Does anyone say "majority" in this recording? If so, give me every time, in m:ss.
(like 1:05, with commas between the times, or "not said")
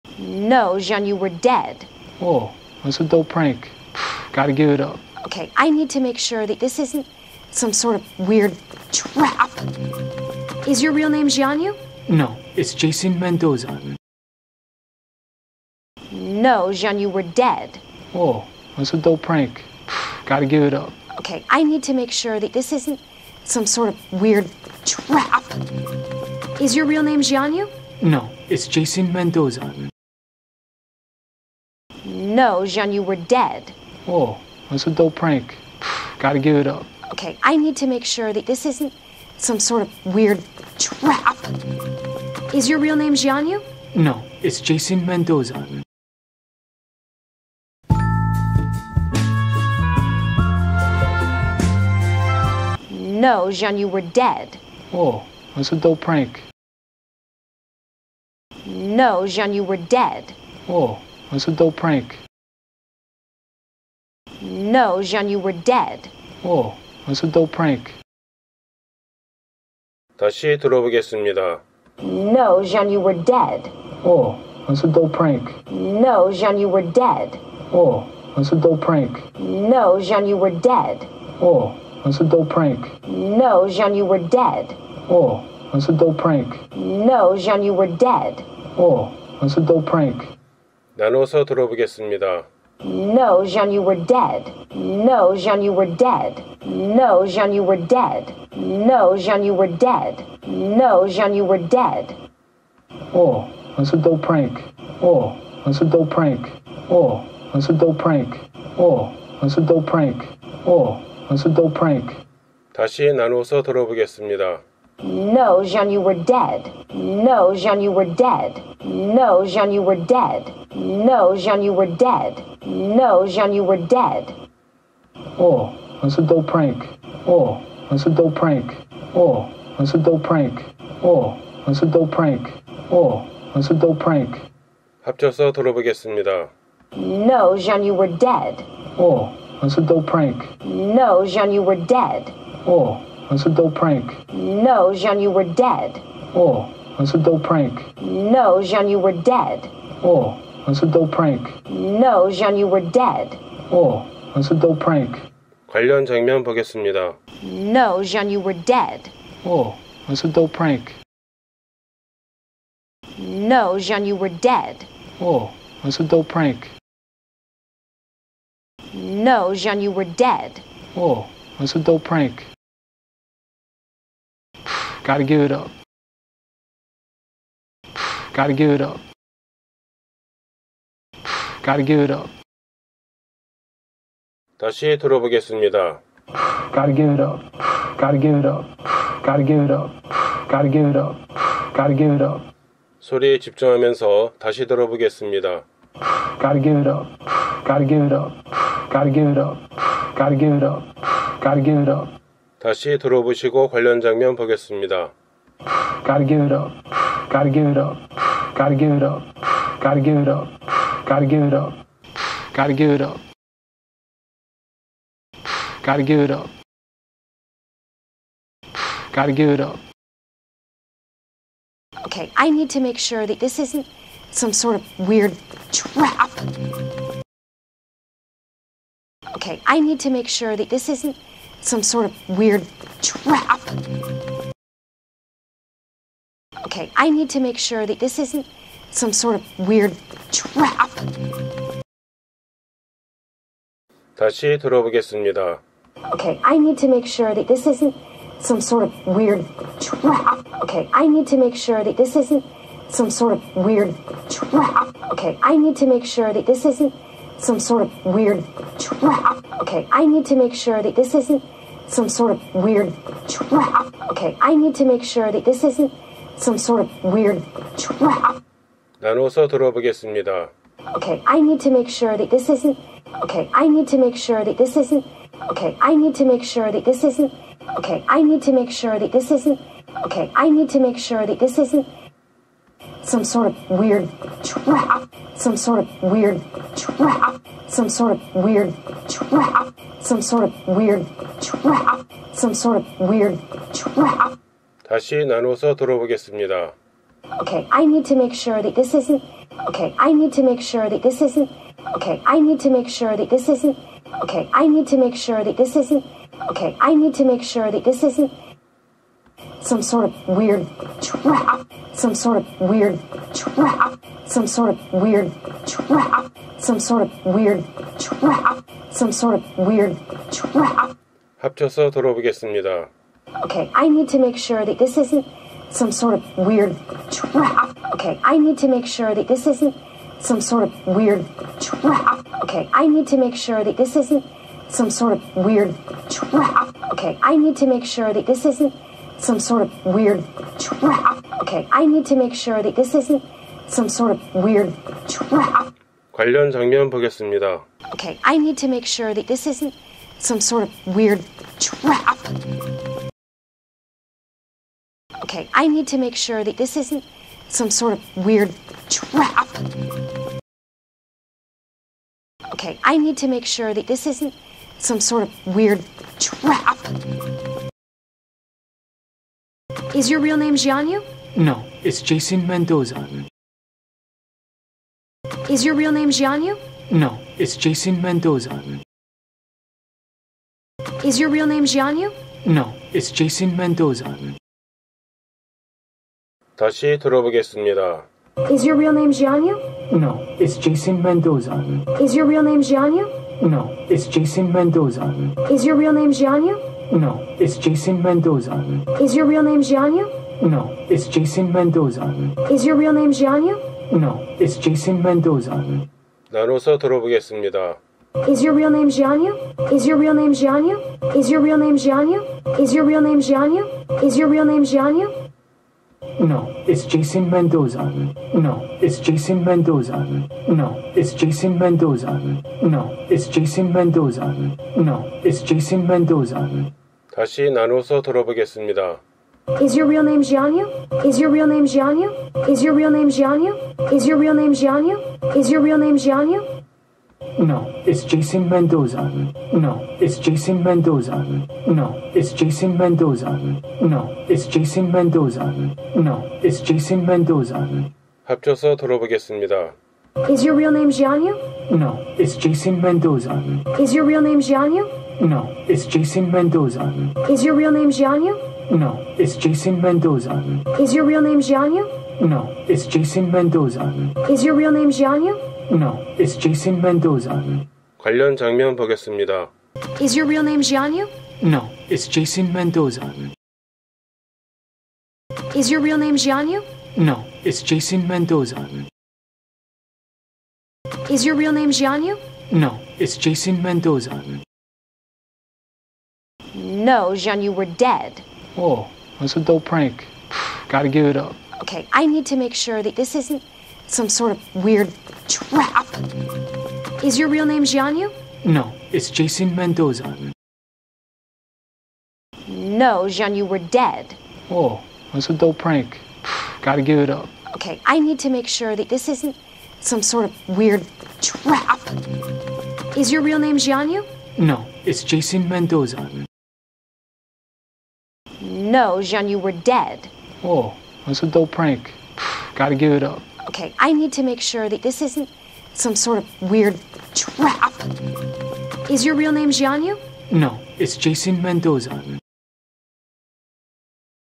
not said.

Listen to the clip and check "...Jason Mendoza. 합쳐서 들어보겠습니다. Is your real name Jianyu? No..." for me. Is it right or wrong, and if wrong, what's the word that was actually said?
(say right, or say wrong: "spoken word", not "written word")
right.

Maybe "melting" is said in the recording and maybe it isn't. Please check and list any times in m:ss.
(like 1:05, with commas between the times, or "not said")
not said.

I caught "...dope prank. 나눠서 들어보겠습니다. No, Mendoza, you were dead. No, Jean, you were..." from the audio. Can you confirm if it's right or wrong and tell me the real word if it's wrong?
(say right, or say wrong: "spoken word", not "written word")
wrong: "Jean", not "Mendoza".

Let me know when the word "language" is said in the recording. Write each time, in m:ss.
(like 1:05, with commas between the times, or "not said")
not said.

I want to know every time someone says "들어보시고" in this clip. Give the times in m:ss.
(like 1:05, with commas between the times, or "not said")
3:22.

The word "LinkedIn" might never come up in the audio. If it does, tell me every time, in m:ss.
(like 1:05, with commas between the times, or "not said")
not said.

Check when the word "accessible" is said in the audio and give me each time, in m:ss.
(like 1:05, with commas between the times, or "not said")
not said.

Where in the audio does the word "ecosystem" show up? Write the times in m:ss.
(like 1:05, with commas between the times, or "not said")
not said.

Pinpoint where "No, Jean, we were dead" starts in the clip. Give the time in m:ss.
8:06.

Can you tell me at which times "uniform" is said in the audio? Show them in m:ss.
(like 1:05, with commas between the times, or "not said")
not said.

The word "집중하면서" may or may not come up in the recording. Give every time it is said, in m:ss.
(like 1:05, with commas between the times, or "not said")
3:13.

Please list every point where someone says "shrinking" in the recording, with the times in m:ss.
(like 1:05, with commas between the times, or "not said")
not said.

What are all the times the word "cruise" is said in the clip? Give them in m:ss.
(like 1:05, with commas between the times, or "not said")
not said.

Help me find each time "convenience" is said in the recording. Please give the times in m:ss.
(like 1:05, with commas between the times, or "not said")
not said.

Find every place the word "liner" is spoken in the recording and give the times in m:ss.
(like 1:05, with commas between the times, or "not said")
not said.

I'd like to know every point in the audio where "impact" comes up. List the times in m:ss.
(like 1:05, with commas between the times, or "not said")
not said.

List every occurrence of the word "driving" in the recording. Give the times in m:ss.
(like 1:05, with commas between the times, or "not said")
not said.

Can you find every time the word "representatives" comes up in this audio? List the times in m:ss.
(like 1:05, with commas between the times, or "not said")
not said.